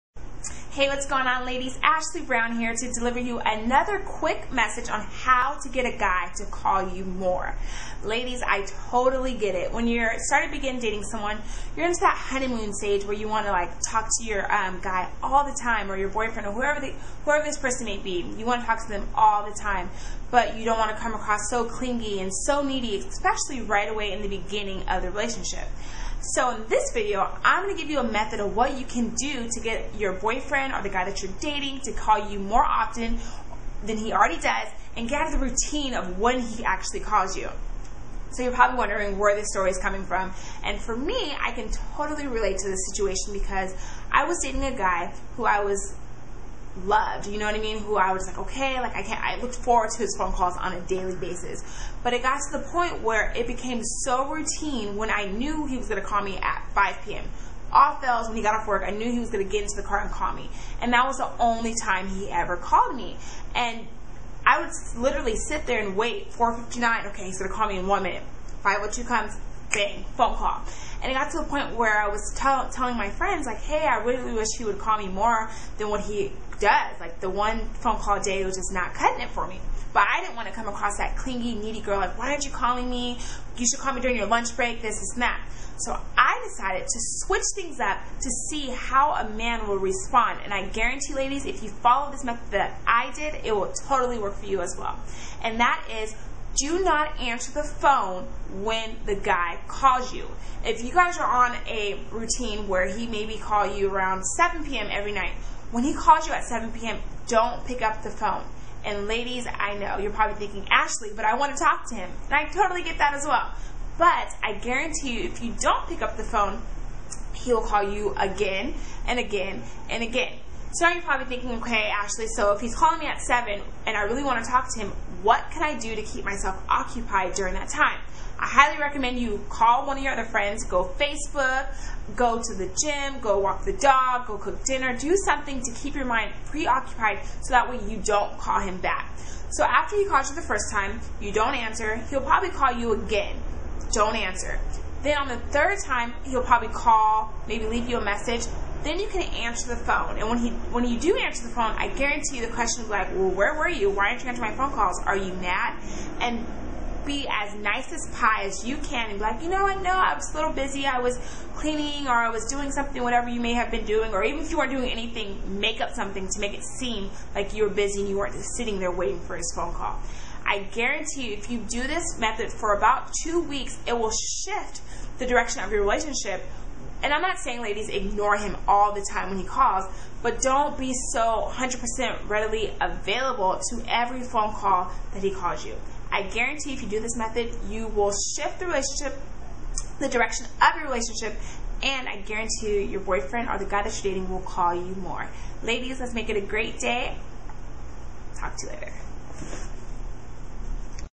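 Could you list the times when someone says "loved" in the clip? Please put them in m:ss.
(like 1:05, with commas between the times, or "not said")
0:46.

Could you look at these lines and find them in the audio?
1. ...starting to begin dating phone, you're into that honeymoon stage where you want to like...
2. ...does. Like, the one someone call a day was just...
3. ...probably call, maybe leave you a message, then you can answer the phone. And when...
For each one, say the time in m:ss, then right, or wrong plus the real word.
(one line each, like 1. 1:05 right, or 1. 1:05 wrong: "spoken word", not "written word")
1. 0:10 wrong: "someone", not "phone"
2. 1:16 wrong: "phone", not "someone"
3. 2:26 right.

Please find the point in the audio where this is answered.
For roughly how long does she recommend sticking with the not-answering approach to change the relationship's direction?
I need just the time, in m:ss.
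2:53.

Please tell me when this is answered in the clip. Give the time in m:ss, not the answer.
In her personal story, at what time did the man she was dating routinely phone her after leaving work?
0:56.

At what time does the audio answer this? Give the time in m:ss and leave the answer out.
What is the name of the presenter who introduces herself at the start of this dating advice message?
0:01.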